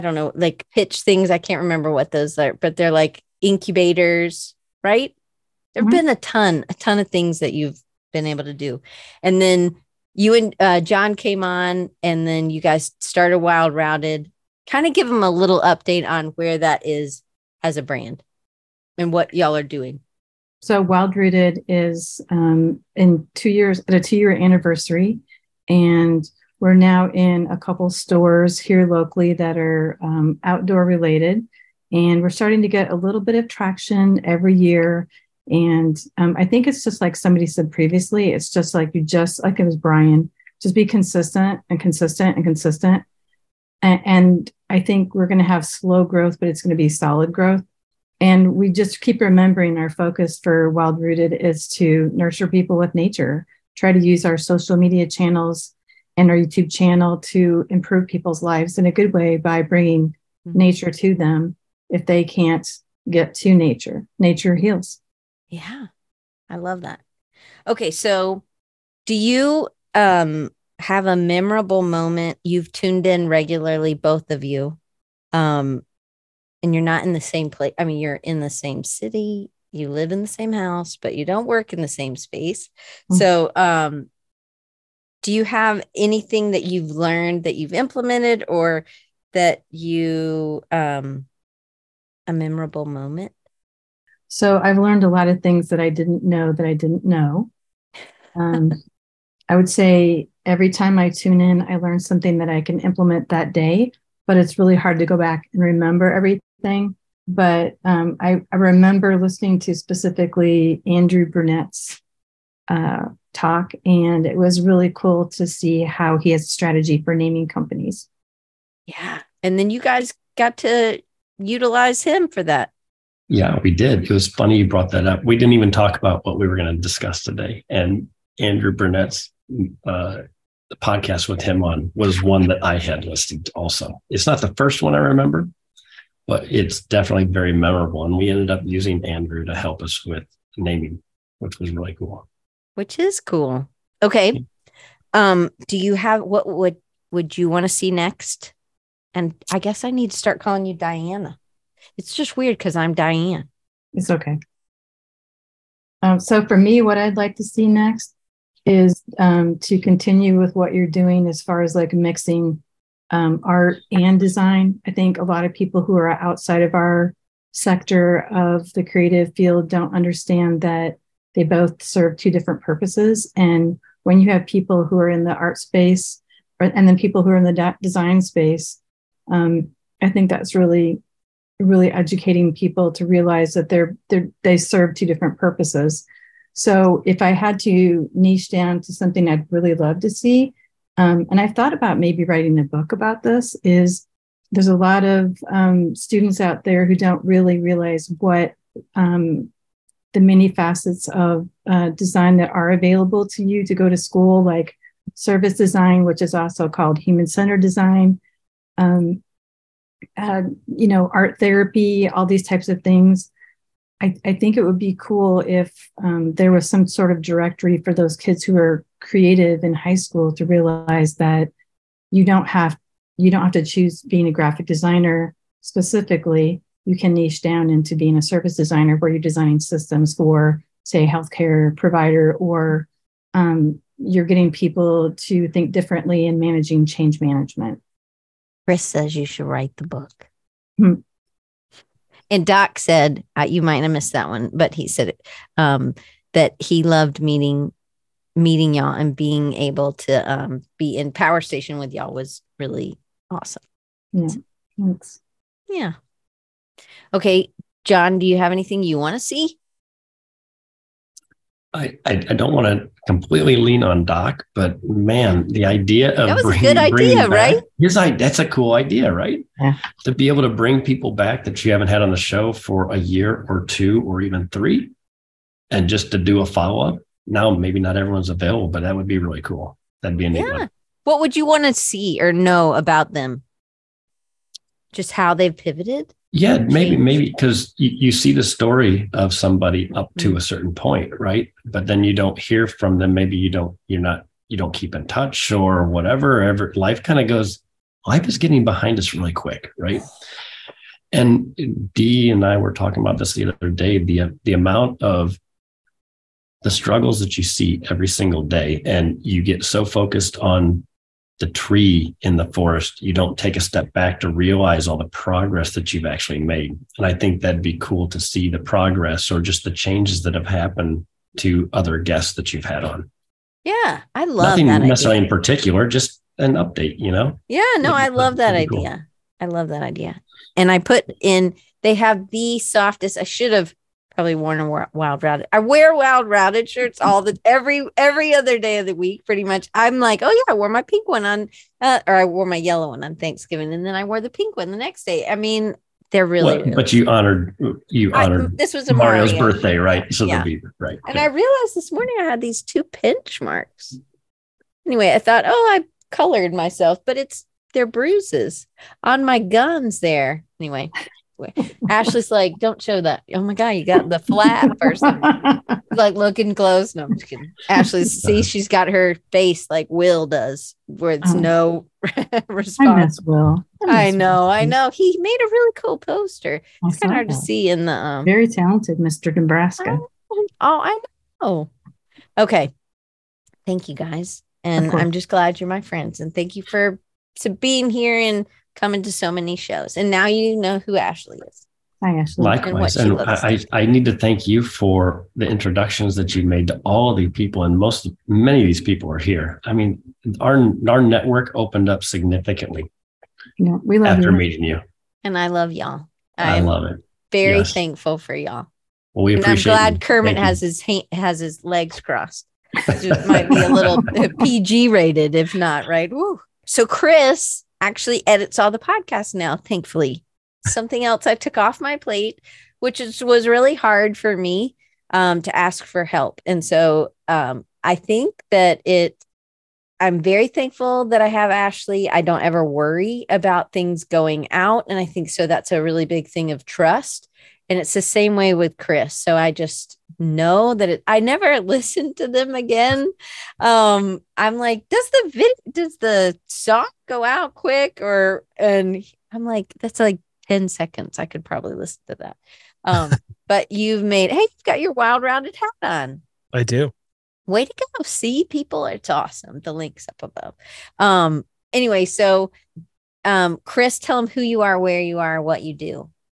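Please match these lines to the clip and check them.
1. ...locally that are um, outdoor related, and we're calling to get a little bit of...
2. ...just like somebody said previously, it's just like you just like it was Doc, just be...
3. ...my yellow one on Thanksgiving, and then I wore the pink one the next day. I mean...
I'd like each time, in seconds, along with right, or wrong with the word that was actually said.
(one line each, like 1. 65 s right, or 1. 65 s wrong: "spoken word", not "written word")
1. 28 s wrong: "starting", not "calling"
2. 36 s wrong: "Brian", not "Doc"
3. 342 s right.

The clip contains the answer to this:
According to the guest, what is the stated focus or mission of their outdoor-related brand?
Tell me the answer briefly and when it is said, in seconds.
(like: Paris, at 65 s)
nurture people with nature, at 52 s.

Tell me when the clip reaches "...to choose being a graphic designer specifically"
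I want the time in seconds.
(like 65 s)
223 s.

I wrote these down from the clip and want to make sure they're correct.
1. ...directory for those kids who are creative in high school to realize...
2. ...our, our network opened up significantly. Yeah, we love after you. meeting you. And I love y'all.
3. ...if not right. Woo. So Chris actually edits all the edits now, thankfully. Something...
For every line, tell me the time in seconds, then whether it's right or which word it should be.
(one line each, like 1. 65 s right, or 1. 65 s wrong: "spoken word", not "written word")
1. 217 s right
2. 400 s right
3. 415 s wrong: "podcasts", not "edits".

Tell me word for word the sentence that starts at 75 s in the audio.
Um, and you're not in the same place.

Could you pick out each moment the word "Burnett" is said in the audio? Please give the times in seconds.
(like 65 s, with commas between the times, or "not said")
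111 s, 128 s.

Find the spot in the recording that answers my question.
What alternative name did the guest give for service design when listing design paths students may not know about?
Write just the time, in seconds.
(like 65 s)
206 s.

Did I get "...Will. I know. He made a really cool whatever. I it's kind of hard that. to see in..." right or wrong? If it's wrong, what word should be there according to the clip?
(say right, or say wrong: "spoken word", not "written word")
wrong: "poster", not "whatever".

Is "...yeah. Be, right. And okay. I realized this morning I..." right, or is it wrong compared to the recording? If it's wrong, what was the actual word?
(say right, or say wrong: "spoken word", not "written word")
right.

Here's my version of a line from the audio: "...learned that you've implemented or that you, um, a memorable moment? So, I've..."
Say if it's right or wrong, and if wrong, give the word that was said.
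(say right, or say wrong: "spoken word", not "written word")
right.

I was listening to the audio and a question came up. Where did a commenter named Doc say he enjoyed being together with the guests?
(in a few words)
Power Station.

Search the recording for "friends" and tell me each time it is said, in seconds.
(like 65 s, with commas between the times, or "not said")
385 s.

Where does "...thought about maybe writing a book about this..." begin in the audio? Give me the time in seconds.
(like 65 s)
191 s.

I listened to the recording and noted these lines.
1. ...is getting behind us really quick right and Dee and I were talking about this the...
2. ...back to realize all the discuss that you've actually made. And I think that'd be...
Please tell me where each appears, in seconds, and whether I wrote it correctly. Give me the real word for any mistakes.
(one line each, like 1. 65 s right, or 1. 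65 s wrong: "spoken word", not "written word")
1. 298 s right
2. 313 s wrong: "progress", not "discuss".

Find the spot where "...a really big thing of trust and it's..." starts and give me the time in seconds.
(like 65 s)
435 s.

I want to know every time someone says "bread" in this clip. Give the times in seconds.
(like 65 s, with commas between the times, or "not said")
not said.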